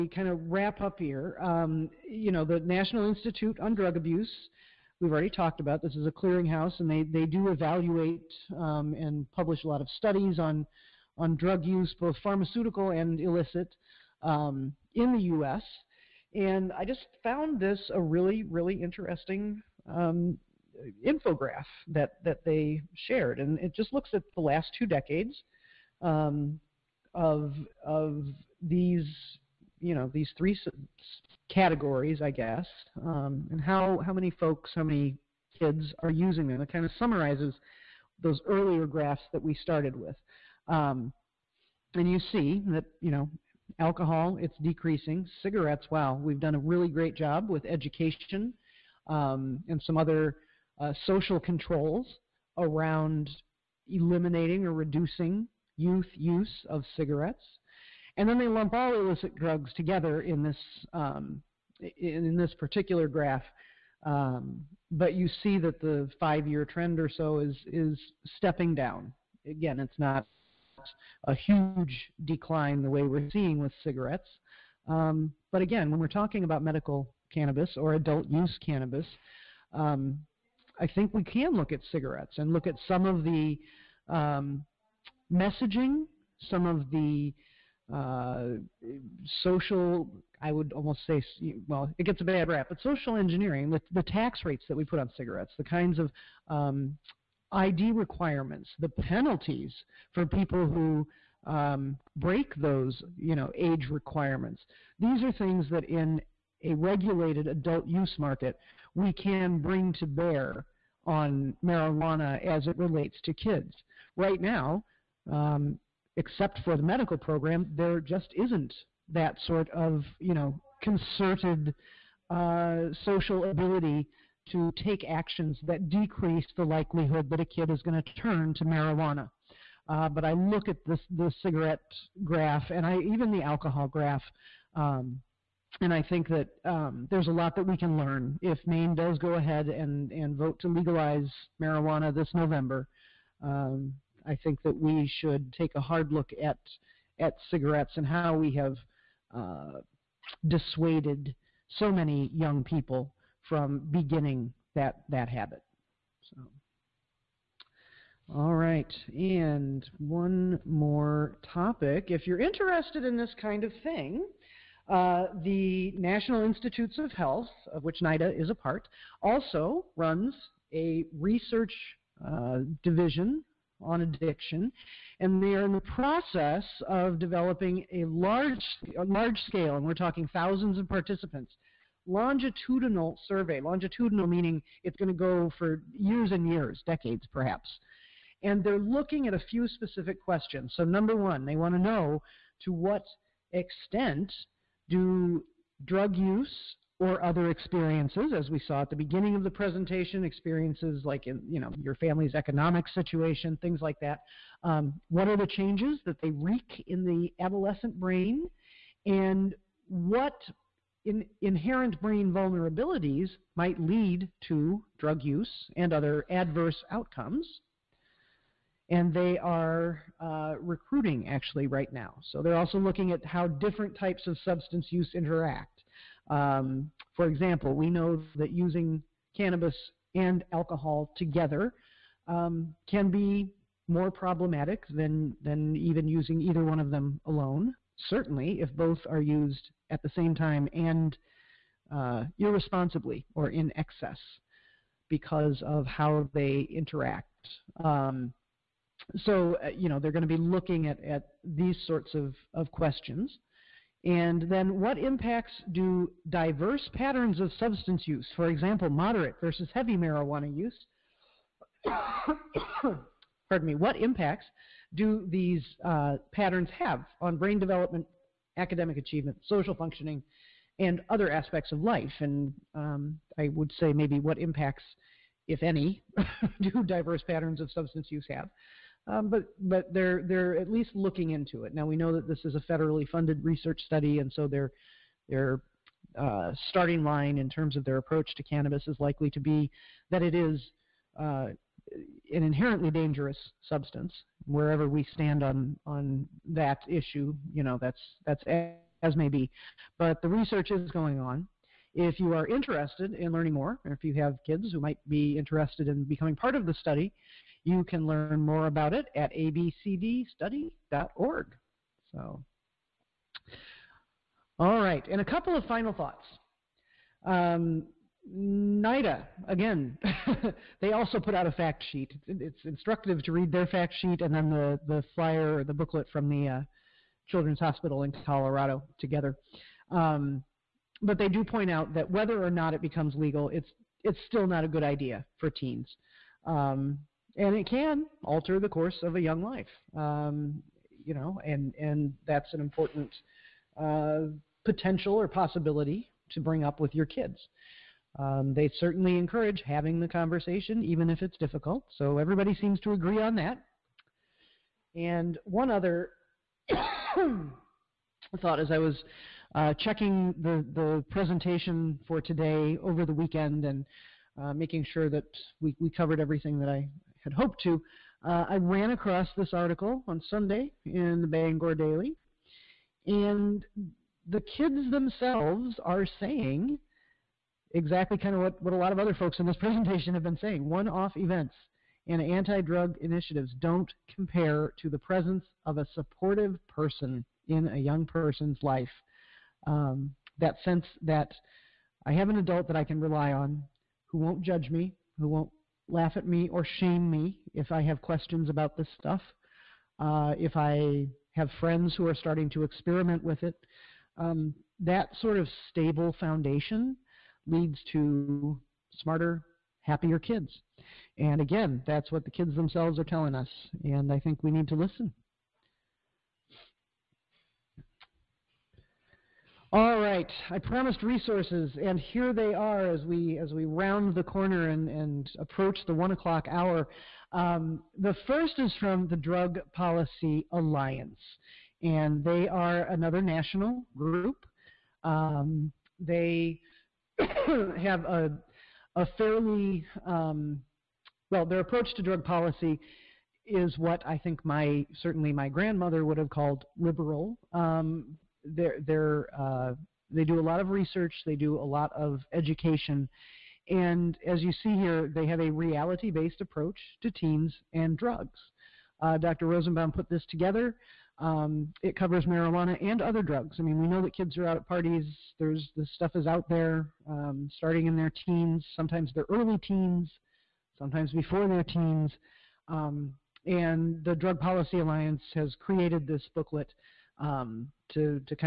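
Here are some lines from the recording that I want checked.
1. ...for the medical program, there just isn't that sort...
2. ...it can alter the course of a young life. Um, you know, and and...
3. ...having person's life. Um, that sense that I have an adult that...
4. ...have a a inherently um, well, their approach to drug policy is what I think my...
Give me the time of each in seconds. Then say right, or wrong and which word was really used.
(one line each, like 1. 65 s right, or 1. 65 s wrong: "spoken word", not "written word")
1. 116 s right
2. 337 s right
3. 387 s wrong: "young", not "having"
4. 437 s wrong: "fairly", not "inherently".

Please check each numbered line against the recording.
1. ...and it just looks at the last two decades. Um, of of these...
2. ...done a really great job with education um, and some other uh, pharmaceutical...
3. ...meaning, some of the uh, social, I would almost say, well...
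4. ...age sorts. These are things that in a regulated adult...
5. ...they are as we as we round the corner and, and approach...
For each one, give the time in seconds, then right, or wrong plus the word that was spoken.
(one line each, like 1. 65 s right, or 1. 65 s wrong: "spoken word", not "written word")
1. 23 s right
2. 46 s wrong: "social", not "pharmaceutical"
3. 85 s wrong: "messaging", not "meaning"
4. 103 s wrong: "requirements", not "sorts"
5. 422 s right.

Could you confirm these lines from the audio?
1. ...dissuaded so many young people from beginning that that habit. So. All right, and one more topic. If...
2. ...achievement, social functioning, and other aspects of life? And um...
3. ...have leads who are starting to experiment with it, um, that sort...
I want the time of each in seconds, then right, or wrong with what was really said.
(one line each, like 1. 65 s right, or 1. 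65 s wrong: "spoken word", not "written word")
1. 150 s right
2. 268 s right
3. 401 s wrong: "friends", not "leads".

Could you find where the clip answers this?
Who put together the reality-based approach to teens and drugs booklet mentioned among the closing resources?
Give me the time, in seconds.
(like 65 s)
459 s.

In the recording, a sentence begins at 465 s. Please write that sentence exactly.
There's this stuff is out there, um, starting in their teens, sometimes their early teens, sometimes before their teens.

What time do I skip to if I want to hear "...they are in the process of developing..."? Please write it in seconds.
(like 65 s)
175 s.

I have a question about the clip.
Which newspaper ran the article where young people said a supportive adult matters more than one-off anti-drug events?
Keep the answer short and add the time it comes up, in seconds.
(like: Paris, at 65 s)
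Bangor Daily, at 371 s.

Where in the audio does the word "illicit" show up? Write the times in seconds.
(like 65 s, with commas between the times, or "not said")
13 s, 58 s.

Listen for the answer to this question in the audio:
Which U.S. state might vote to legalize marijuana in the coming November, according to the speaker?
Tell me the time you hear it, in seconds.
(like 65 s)
138 s.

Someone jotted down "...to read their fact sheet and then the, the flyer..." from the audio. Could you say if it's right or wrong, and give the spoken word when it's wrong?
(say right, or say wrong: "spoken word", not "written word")
right.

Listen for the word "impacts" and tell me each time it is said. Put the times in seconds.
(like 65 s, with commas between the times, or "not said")
254 s, 263 s, 274 s.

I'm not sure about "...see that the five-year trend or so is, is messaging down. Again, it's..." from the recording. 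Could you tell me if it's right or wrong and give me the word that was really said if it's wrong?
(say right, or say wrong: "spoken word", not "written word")
wrong: "stepping", not "messaging".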